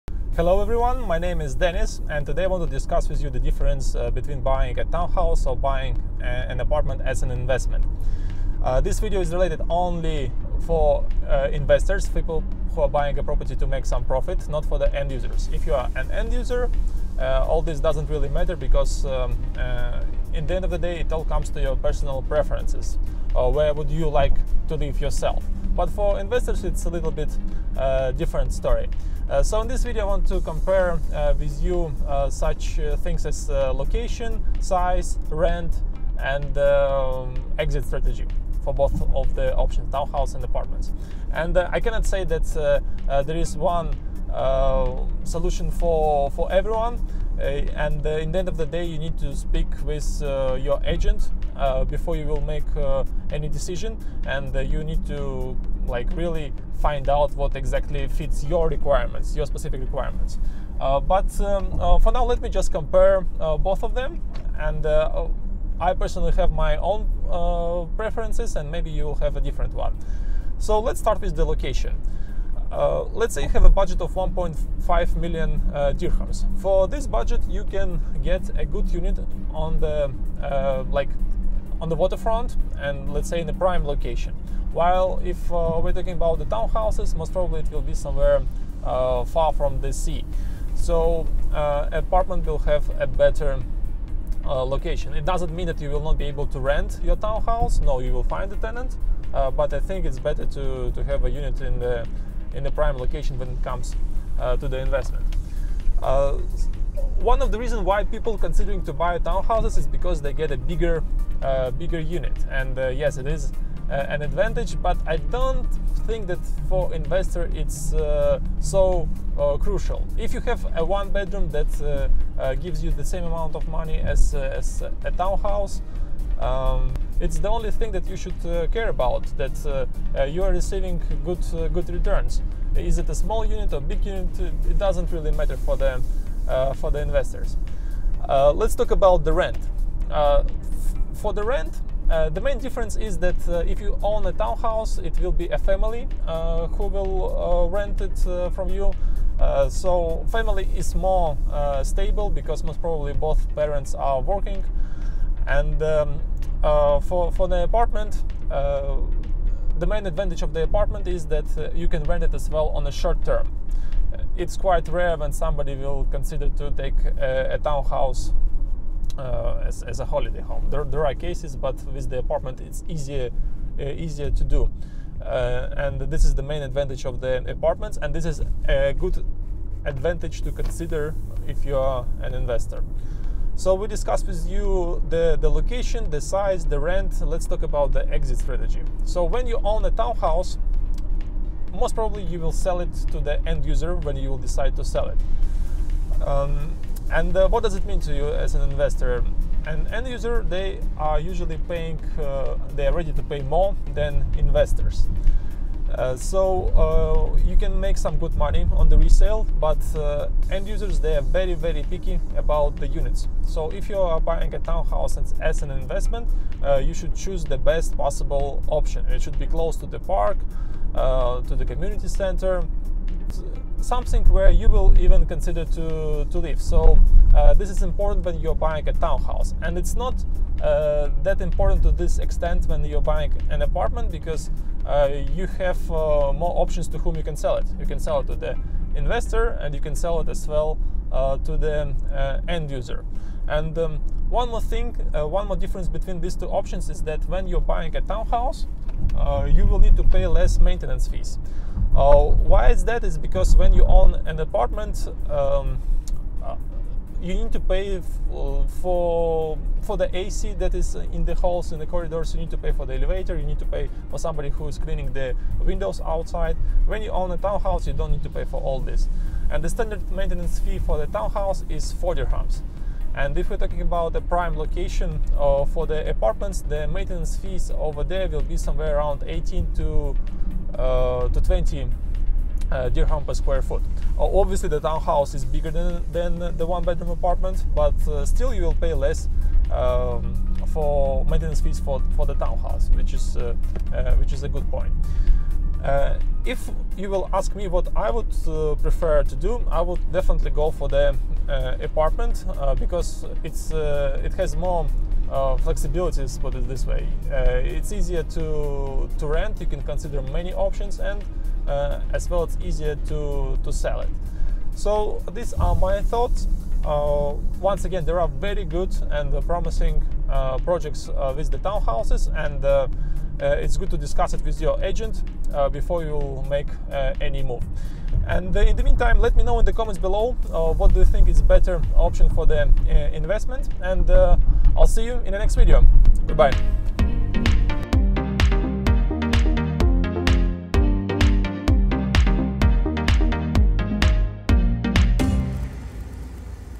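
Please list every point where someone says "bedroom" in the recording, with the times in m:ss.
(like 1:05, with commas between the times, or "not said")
2:01, 4:46.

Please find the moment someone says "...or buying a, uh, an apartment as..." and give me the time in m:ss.
0:05.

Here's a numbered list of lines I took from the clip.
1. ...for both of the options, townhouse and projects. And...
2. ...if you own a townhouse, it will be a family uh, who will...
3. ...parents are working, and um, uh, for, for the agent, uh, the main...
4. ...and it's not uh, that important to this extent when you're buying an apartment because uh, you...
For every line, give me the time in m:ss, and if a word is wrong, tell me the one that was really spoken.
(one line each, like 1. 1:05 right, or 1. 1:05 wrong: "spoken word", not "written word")
1. 0:38 wrong: "apartments", not "projects"
2. 2:23 right
3. 2:33 wrong: "apartment", not "agent"
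4. 3:49 right.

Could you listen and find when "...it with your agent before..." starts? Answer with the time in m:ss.
5:24.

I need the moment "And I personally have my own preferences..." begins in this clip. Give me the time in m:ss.
1:04.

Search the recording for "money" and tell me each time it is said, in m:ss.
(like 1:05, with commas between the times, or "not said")
2:03, 3:28.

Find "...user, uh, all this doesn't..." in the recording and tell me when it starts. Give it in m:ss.
0:16.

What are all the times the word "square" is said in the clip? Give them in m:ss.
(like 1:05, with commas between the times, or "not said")
4:43.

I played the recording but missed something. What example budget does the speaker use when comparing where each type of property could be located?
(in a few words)
1.5 million dirhams.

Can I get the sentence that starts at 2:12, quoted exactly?
Is it a small unit or big unit?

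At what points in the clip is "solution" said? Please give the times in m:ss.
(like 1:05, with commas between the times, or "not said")
0:45.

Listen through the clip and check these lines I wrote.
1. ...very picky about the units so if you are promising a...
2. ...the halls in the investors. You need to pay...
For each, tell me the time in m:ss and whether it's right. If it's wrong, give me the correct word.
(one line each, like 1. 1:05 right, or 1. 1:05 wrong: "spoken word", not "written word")
1. 3:31 wrong: "buying", not "promising"
2. 4:21 wrong: "corridors", not "investors".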